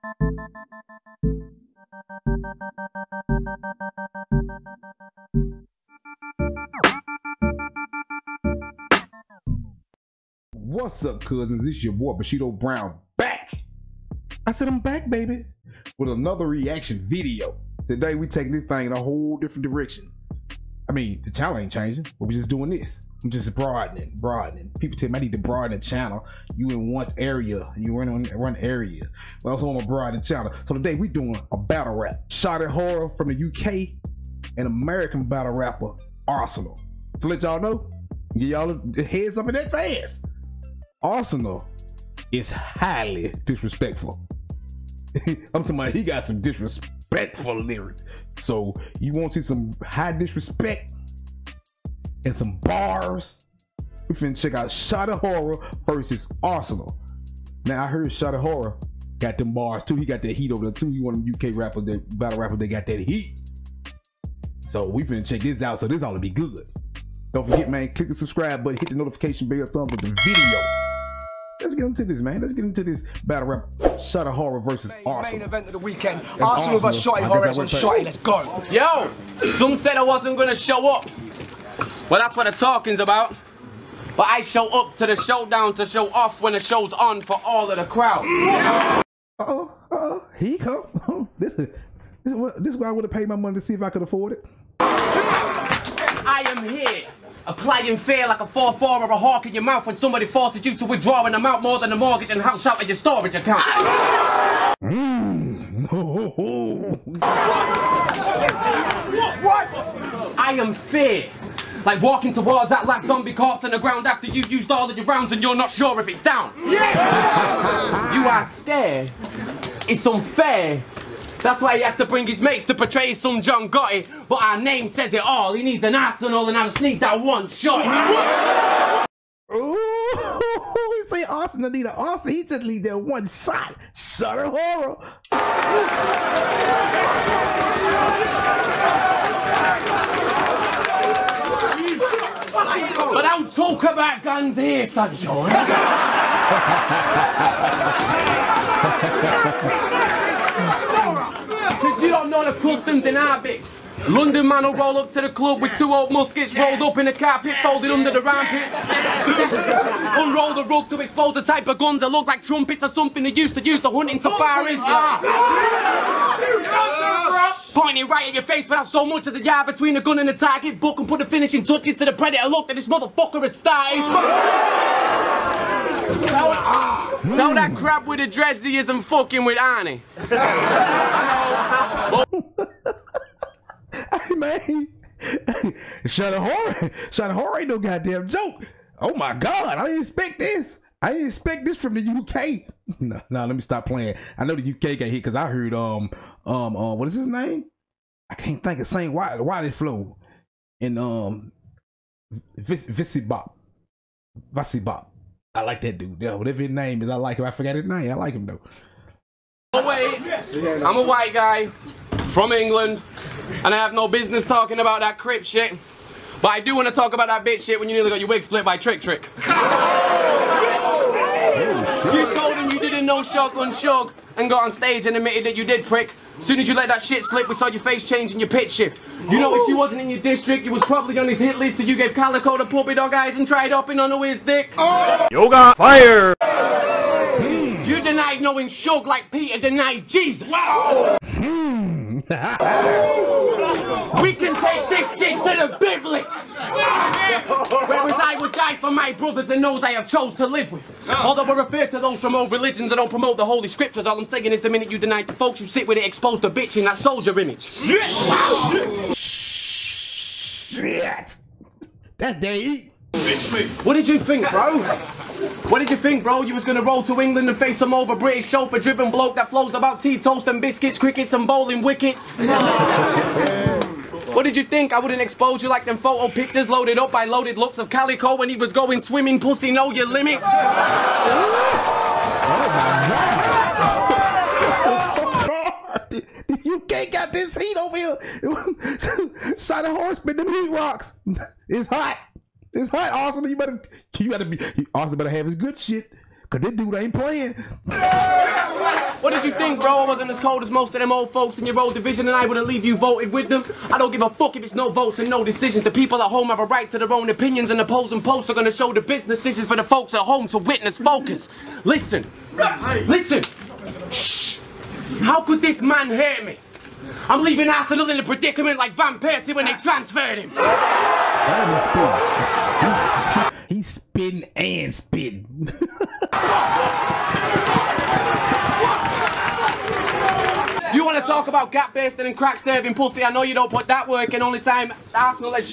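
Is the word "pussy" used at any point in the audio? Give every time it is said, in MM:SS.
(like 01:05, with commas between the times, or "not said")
04:39, 05:32.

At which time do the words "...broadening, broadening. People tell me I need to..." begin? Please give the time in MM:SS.
00:23.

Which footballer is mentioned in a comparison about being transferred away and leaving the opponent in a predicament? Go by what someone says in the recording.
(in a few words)
Van Persie.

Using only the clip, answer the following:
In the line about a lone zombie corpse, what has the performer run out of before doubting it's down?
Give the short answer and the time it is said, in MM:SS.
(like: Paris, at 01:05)
rounds, at 01:55.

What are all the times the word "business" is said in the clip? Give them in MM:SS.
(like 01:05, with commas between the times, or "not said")
03:34, 05:09.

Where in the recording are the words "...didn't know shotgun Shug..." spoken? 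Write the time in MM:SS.
03:42.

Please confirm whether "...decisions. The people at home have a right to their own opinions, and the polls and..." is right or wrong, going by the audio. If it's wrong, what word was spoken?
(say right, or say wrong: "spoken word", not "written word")
right.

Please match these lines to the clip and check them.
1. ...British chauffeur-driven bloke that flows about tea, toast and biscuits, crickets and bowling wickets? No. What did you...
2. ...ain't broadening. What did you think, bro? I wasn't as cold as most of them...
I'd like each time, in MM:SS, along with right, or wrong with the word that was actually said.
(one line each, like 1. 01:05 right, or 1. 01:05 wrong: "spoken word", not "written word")
1. 04:28 right
2. 04:56 wrong: "playing", not "broadening".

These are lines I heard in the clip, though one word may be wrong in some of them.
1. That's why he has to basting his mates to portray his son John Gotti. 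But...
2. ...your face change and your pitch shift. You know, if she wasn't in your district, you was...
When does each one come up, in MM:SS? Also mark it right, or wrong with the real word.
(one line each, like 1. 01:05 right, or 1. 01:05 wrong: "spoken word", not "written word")
1. 02:01 wrong: "bring", not "basting"
2. 03:47 right.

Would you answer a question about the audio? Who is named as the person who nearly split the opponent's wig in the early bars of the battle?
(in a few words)
Trick Trick.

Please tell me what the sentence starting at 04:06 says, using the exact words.
Whereas I would die for my brothers and those I have chose to live with.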